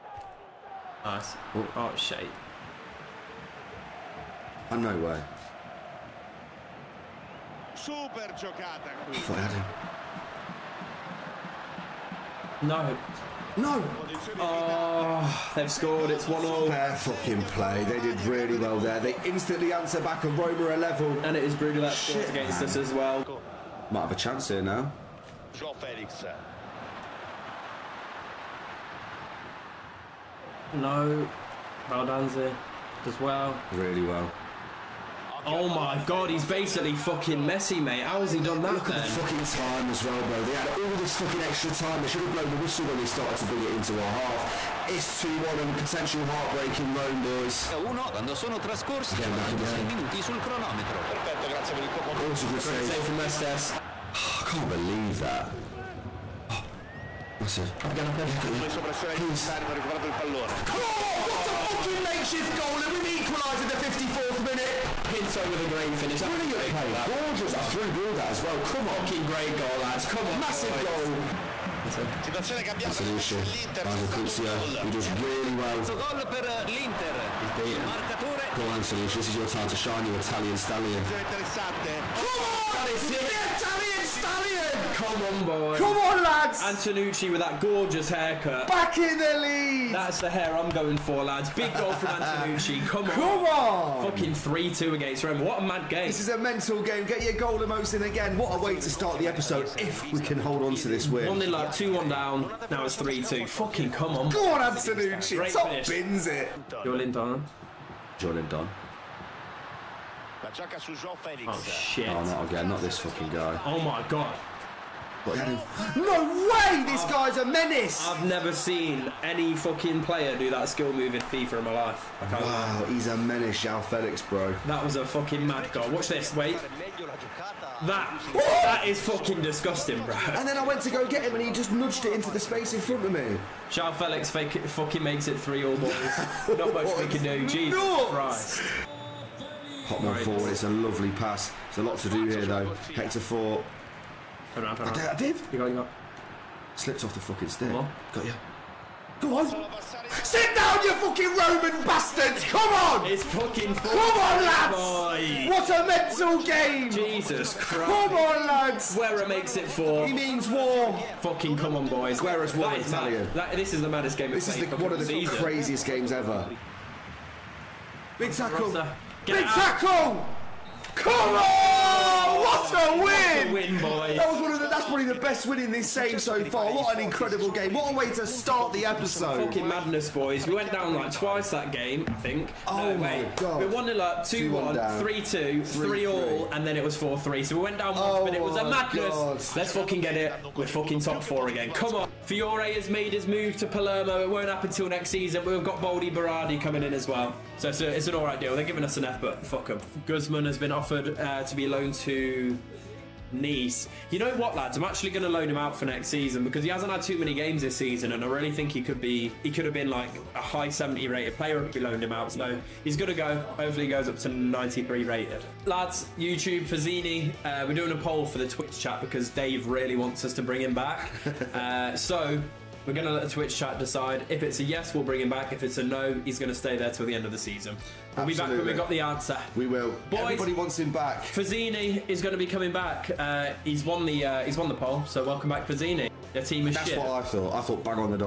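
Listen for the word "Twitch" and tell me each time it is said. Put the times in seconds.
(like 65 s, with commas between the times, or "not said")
218 s, 223 s.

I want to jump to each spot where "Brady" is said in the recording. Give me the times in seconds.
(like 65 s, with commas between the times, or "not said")
not said.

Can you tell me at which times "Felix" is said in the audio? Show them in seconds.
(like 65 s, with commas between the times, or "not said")
25 s, 123 s, 133 s.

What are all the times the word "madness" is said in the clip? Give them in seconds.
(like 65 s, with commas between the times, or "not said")
179 s, 188 s.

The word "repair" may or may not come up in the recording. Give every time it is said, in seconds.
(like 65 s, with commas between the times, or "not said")
not said.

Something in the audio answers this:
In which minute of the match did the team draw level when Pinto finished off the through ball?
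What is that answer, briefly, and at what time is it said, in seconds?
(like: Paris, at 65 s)
54th minute, at 63 s.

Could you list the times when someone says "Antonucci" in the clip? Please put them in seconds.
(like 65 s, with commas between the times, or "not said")
72 s, 78 s, 86 s, 92 s, 104 s.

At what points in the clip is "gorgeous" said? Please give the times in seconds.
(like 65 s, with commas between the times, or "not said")
67 s, 87 s.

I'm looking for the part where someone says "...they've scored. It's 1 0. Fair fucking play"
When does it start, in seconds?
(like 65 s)
15 s.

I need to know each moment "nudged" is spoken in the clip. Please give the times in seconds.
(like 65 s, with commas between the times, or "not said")
131 s.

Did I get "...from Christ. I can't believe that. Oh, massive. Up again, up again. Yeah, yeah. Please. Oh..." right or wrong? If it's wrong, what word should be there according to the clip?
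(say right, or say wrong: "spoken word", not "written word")
wrong: "Restes", not "Christ".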